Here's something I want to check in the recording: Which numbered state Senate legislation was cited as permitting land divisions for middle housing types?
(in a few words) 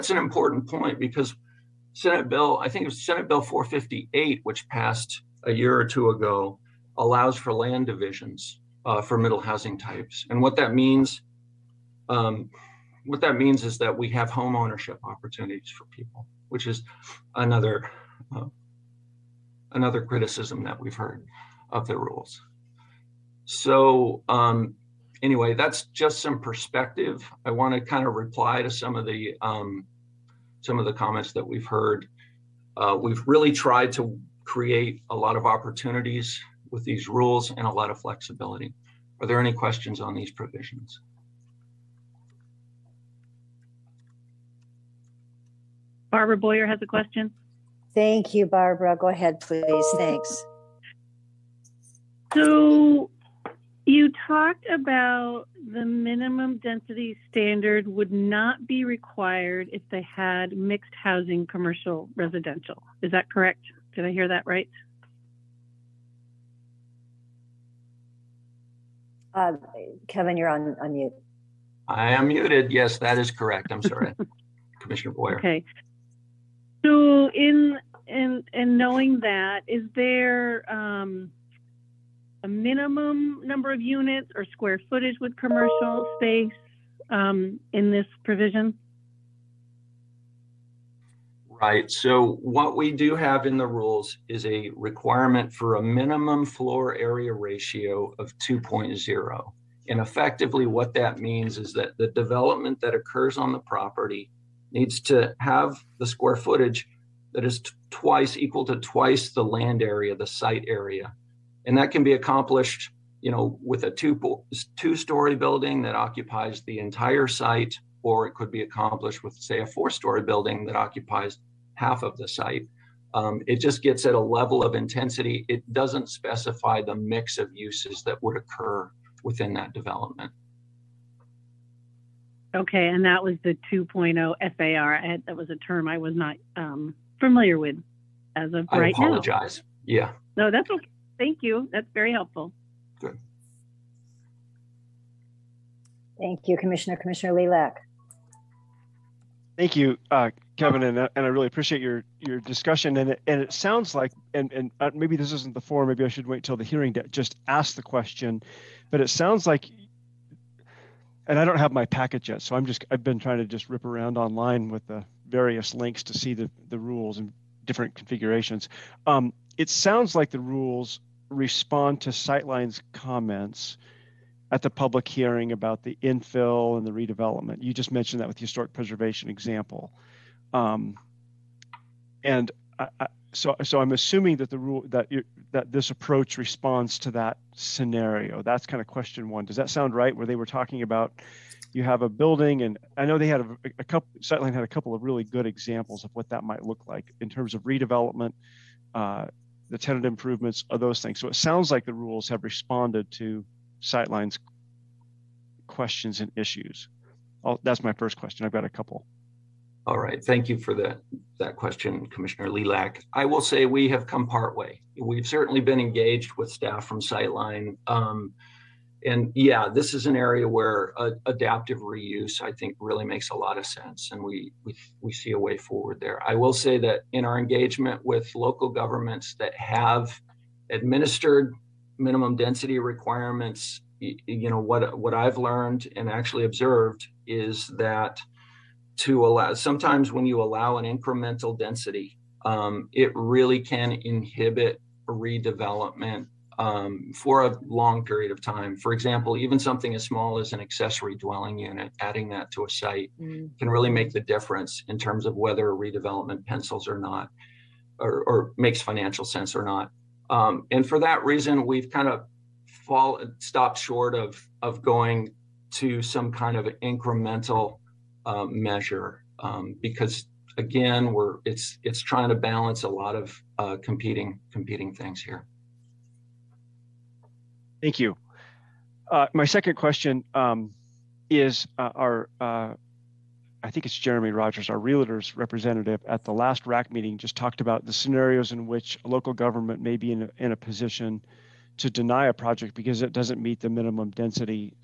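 Senate Bill 458.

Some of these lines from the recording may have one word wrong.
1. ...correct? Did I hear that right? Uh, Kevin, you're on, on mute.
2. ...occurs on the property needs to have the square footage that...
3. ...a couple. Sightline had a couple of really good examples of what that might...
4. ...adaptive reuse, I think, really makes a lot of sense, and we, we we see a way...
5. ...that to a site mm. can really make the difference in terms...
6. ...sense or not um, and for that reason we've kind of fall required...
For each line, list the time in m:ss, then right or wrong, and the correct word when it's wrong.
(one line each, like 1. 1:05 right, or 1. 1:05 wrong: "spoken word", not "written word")
1. 1:03 right
2. 1:42 right
3. 3:13 right
4. 3:41 right
5. 4:12 right
6. 4:19 wrong: "stopped", not "required".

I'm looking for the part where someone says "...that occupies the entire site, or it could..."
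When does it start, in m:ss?
1:55.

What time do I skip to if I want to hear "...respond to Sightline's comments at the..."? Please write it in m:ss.
2:51.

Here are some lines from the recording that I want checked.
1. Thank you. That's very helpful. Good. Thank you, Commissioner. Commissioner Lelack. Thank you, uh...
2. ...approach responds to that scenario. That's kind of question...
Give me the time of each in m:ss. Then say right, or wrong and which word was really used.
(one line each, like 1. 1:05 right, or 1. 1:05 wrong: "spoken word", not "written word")
1. 2:21 right
2. 3:05 right.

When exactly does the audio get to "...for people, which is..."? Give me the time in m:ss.
0:15.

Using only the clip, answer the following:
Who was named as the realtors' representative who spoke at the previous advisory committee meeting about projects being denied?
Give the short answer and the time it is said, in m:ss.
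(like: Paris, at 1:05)
Jeremy Rogers, at 4:43.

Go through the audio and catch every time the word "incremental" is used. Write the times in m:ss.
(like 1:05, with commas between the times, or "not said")
4:00, 4:26.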